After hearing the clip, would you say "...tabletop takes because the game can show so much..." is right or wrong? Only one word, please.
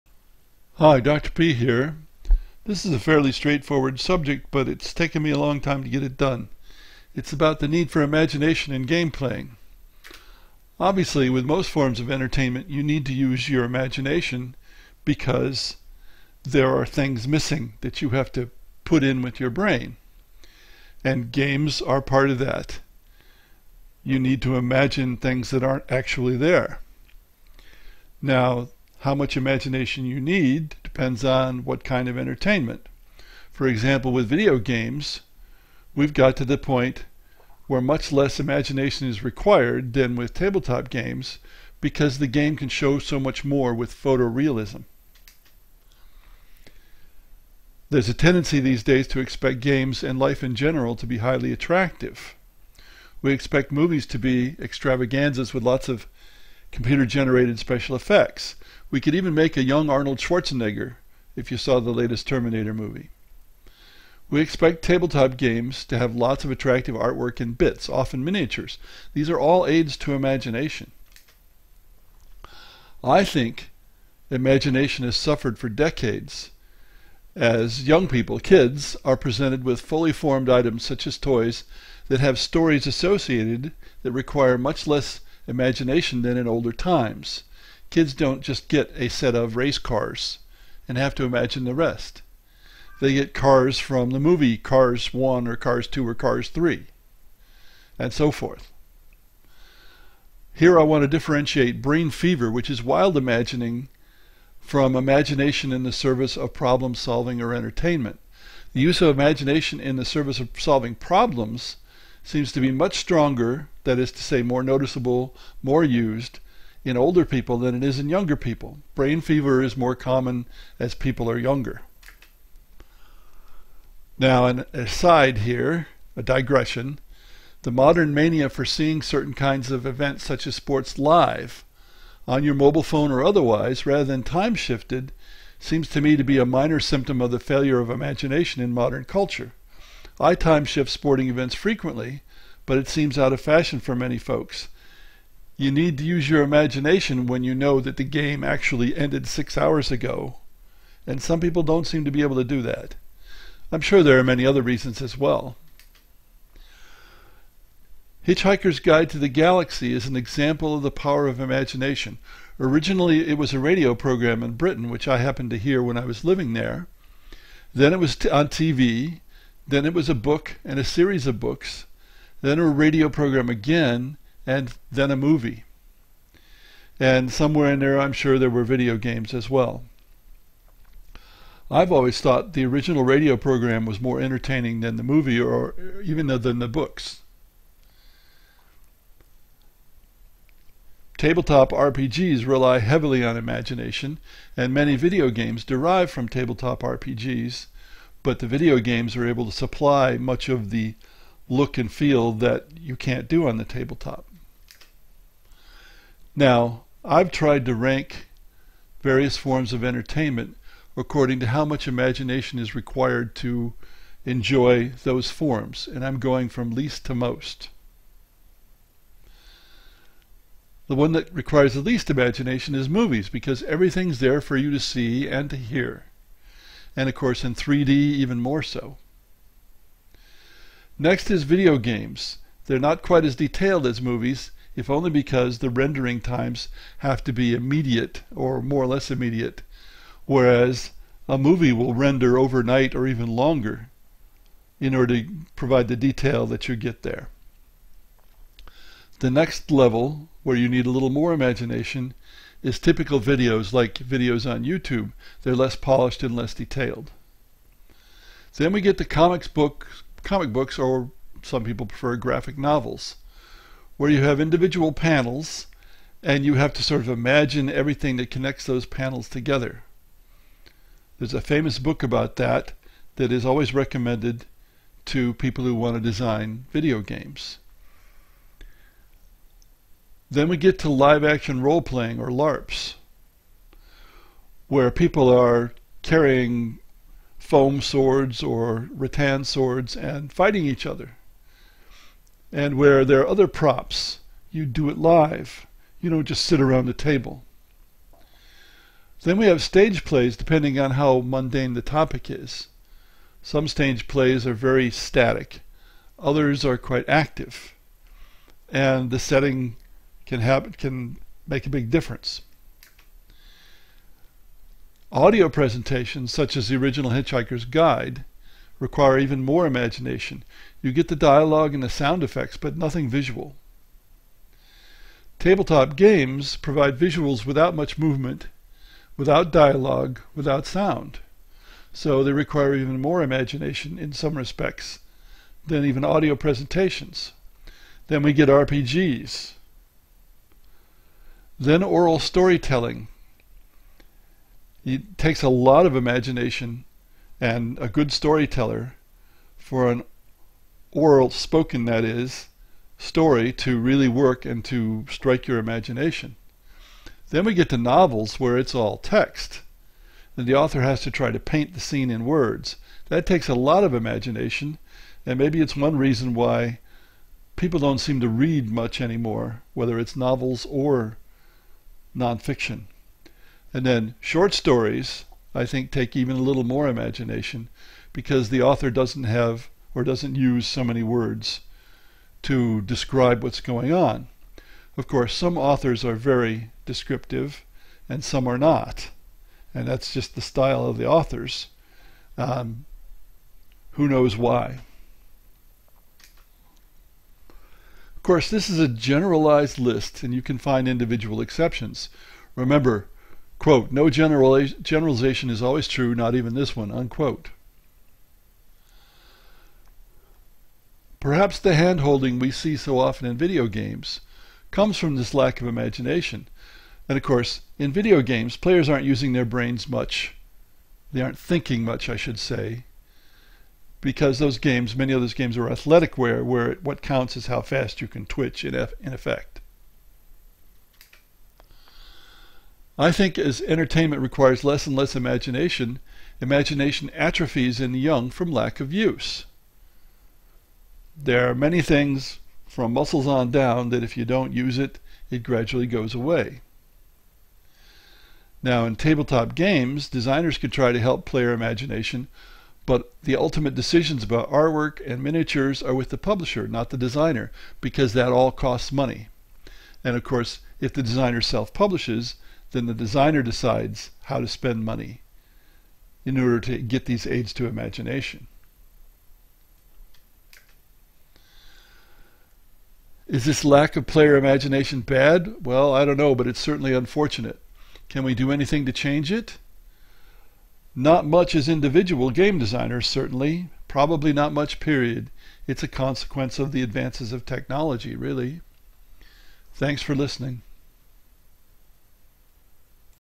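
wrong.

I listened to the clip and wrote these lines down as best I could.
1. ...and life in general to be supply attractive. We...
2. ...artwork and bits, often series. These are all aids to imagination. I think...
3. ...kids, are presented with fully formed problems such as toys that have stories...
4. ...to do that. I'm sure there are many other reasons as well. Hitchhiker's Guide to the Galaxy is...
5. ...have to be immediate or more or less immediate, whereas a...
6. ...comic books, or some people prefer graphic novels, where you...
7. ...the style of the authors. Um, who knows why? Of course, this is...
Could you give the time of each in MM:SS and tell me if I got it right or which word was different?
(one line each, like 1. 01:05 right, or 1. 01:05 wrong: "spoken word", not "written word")
1. 00:50 wrong: "highly", not "supply"
2. 01:06 wrong: "miniatures", not "series"
3. 01:18 wrong: "items", not "problems"
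4. 02:32 right
5. 03:56 right
6. 04:20 right
7. 06:30 right.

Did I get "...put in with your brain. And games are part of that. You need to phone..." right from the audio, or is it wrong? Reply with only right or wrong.
wrong.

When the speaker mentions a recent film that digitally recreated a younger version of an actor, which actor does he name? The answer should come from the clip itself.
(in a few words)
Arnold Schwarzenegger.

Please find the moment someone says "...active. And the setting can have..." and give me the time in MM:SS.
05:07.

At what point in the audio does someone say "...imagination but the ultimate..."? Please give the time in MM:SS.
07:31.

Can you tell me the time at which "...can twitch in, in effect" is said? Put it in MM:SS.
07:08.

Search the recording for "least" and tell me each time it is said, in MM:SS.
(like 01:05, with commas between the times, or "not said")
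03:36, 03:41.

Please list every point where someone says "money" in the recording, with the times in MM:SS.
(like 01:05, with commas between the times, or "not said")
07:38, 07:44.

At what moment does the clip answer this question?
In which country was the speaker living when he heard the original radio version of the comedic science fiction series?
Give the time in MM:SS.
02:44.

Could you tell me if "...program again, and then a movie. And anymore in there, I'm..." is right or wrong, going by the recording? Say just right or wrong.
wrong.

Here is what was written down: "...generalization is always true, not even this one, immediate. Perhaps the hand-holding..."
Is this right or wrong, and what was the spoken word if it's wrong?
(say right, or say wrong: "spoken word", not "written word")
wrong: "unquote", not "immediate".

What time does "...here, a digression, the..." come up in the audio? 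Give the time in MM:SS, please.
02:05.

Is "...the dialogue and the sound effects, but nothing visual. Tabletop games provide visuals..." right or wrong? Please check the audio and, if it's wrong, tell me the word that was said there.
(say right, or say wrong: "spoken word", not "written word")
right.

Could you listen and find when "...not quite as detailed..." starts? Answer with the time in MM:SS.
03:52.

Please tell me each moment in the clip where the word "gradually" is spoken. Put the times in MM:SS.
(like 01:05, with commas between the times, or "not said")
07:25.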